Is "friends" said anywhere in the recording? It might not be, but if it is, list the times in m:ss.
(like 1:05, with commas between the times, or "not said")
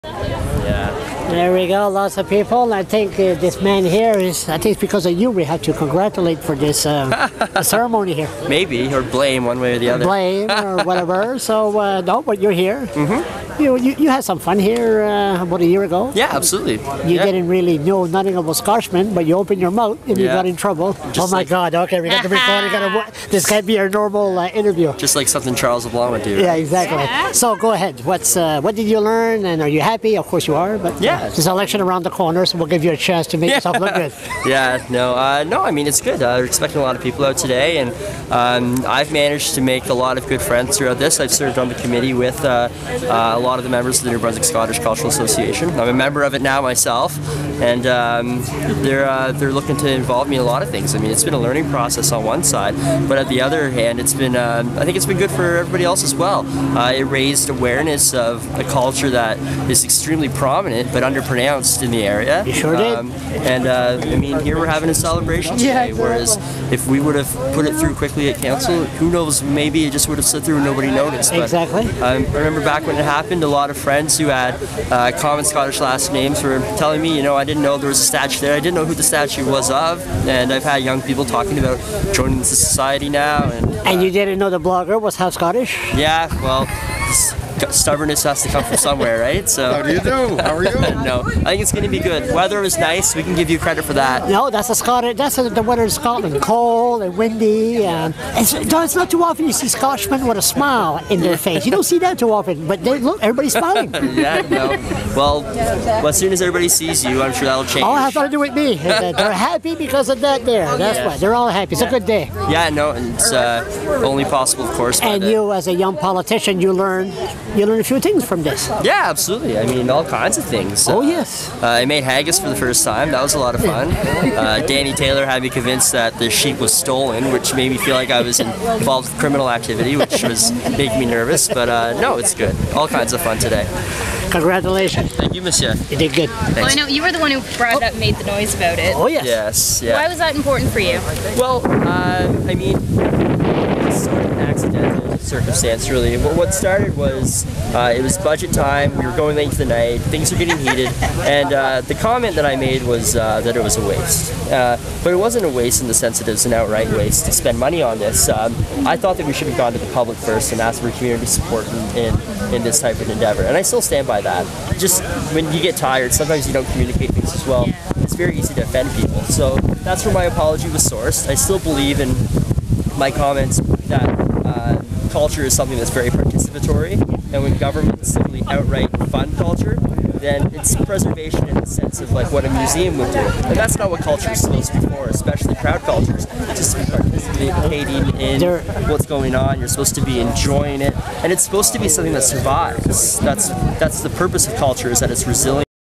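0:40, 1:13.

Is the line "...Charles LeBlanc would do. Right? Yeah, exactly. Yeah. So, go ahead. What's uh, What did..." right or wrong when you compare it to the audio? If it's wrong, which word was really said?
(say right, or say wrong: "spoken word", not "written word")
right.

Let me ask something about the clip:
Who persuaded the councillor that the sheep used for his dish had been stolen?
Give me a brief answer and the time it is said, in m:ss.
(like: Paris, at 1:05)
Danny Taylor, at 2:04.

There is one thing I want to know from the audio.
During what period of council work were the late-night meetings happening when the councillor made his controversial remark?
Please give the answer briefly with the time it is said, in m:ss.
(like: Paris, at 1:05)
budget time, at 2:28.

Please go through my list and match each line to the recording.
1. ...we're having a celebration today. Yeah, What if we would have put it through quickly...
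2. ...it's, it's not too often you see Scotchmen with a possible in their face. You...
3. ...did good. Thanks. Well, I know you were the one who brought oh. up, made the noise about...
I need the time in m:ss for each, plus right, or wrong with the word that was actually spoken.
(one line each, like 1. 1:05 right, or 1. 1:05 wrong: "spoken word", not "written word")
1. 1:04 wrong: "Whereas", not "What"
2. 1:38 wrong: "smile", not "possible"
3. 2:15 right.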